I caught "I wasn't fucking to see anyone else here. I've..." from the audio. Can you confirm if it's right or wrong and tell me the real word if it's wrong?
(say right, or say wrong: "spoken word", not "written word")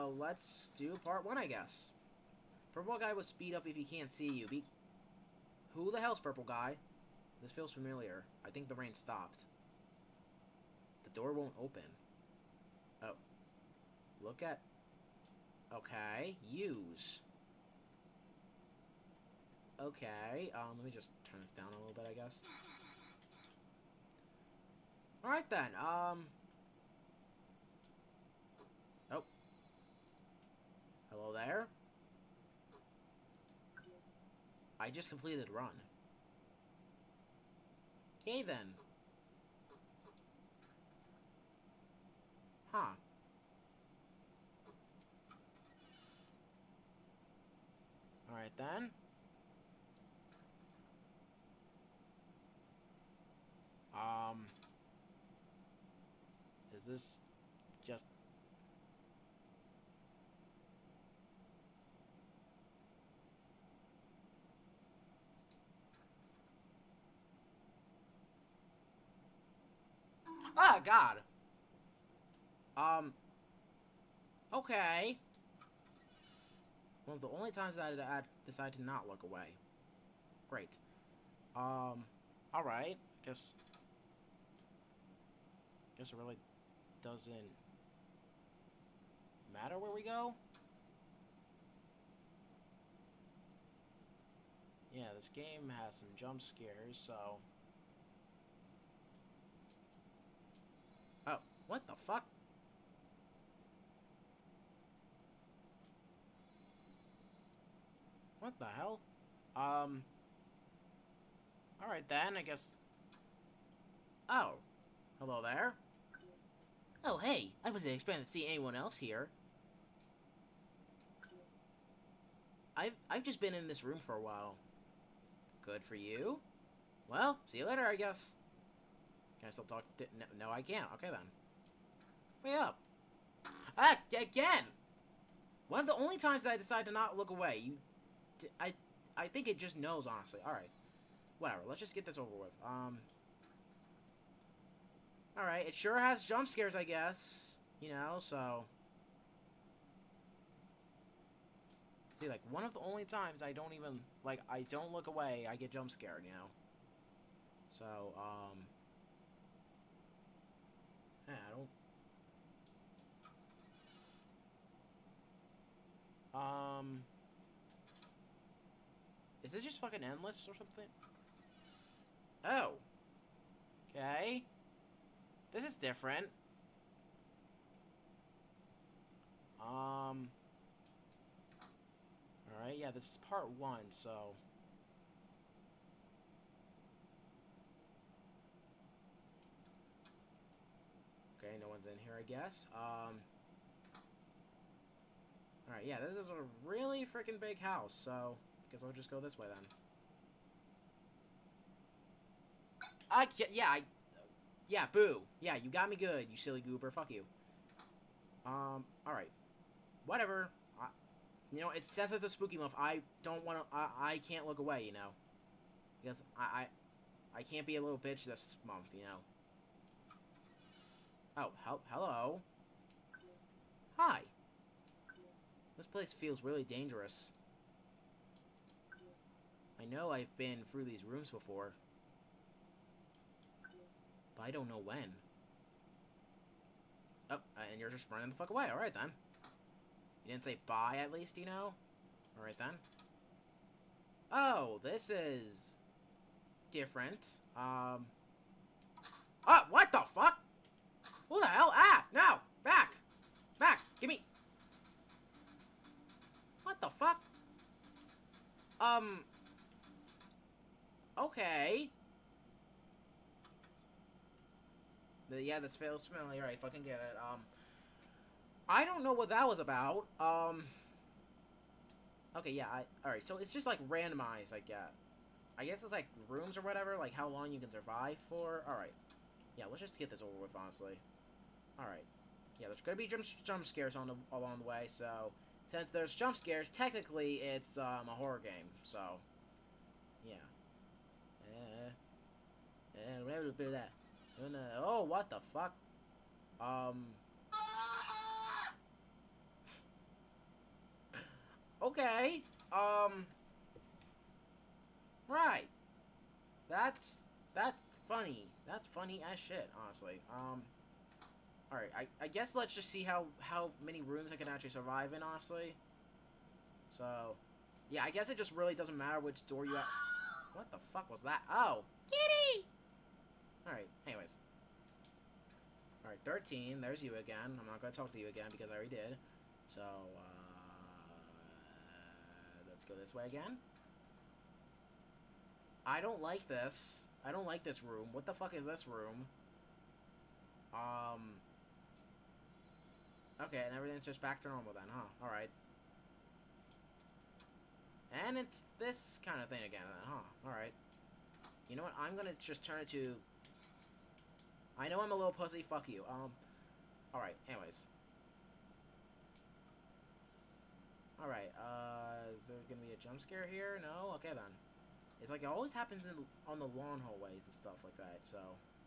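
wrong: "expecting", not "fucking".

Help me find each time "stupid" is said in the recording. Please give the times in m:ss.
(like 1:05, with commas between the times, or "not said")
not said.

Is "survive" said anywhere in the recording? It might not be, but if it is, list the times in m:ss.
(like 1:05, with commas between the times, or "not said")
4:37, 5:14.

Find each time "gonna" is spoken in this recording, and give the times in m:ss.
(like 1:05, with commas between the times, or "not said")
4:42, 5:52, 6:02.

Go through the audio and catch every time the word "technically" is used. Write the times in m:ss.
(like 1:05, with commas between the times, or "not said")
4:46.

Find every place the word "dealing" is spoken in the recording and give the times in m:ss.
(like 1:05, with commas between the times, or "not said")
not said.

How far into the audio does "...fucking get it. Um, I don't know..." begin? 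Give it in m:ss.
4:26.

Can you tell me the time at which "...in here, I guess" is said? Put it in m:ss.
3:11.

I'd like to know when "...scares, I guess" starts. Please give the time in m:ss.
2:26.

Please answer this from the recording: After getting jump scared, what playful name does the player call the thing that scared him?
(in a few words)
Silly goober.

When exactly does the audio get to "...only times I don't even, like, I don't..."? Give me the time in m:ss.
2:32.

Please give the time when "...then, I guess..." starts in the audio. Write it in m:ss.
1:52.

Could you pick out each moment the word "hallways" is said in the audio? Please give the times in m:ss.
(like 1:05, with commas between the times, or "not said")
6:07.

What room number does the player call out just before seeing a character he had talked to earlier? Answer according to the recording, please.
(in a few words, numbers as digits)
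13.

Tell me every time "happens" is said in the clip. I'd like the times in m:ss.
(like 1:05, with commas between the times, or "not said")
6:05.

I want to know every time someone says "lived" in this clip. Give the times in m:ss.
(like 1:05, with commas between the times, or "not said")
not said.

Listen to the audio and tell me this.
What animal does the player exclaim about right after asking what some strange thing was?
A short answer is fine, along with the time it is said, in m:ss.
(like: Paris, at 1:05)
Kitty, at 5:22.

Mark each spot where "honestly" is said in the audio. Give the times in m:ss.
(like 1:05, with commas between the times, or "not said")
2:20, 4:40, 5:09, 5:15.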